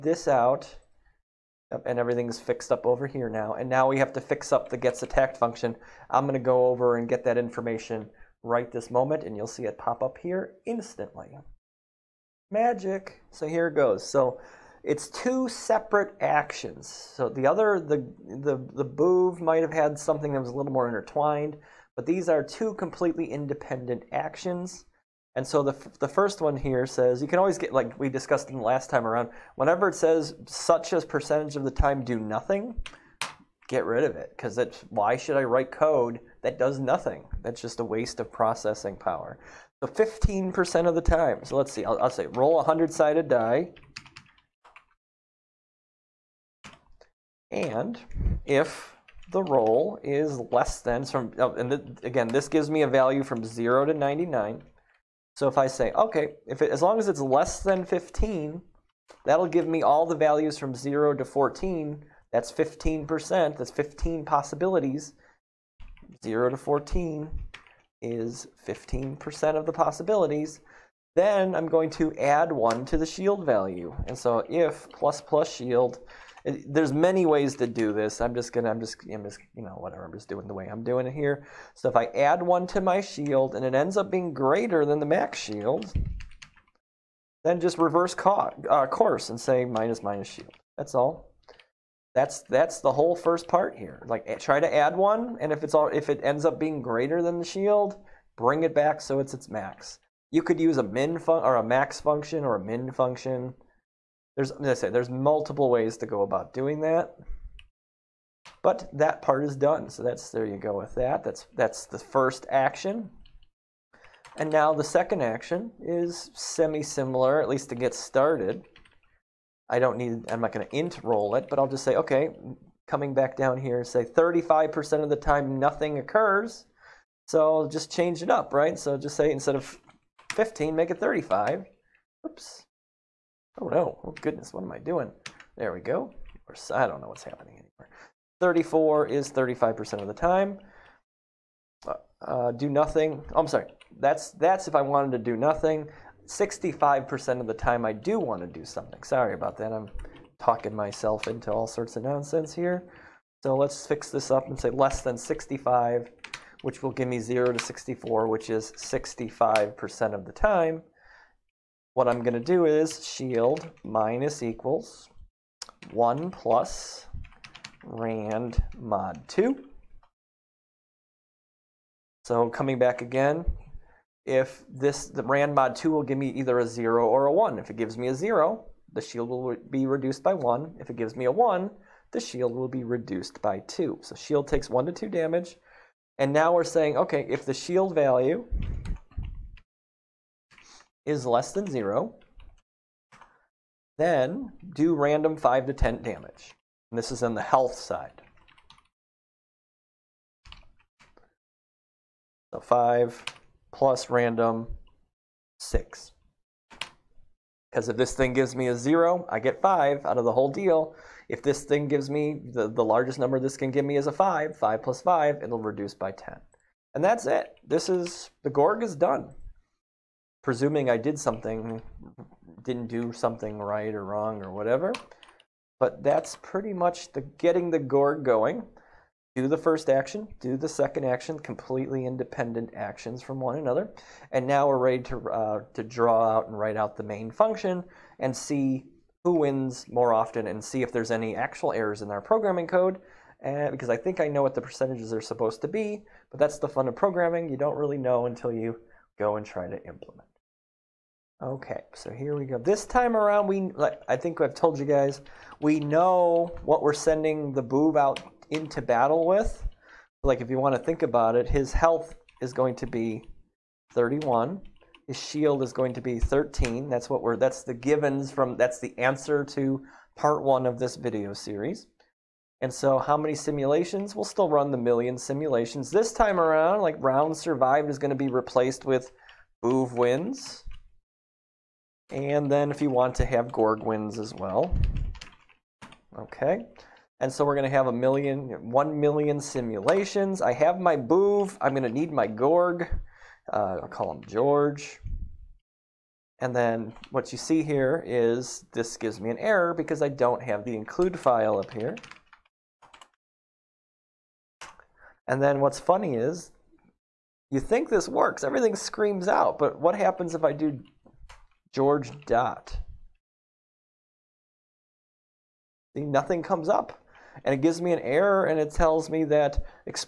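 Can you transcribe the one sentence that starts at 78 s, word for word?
I'm just gonna, I'm just, I'm just, you know, whatever.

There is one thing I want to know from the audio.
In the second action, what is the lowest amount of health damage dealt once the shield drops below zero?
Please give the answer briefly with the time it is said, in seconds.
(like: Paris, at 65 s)
5, at 209 s.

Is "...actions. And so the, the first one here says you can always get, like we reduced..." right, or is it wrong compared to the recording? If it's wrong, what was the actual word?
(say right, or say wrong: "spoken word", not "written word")
wrong: "discussed", not "reduced".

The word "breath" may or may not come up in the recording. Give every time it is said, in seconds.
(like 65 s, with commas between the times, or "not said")
not said.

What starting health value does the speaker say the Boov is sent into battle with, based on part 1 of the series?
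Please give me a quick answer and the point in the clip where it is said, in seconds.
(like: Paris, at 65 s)
31, at 261 s.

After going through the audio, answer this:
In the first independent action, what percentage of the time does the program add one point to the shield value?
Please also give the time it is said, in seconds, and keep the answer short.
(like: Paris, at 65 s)
15%, at 39 s.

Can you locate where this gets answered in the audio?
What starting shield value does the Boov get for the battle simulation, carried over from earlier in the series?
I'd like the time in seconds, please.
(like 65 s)
265 s.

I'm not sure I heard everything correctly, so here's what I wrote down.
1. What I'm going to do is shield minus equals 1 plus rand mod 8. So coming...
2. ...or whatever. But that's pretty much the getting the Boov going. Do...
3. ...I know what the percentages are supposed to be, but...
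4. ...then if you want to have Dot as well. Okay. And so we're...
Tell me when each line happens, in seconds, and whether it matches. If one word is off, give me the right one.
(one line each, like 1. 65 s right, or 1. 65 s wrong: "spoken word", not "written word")
1. 161 s wrong: "2", not "8"
2. 224 s wrong: "Gorg", not "Boov"
3. 244 s right
4. 282 s wrong: "Gorgwins", not "Dot".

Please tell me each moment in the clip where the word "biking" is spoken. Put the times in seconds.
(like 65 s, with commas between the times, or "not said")
not said.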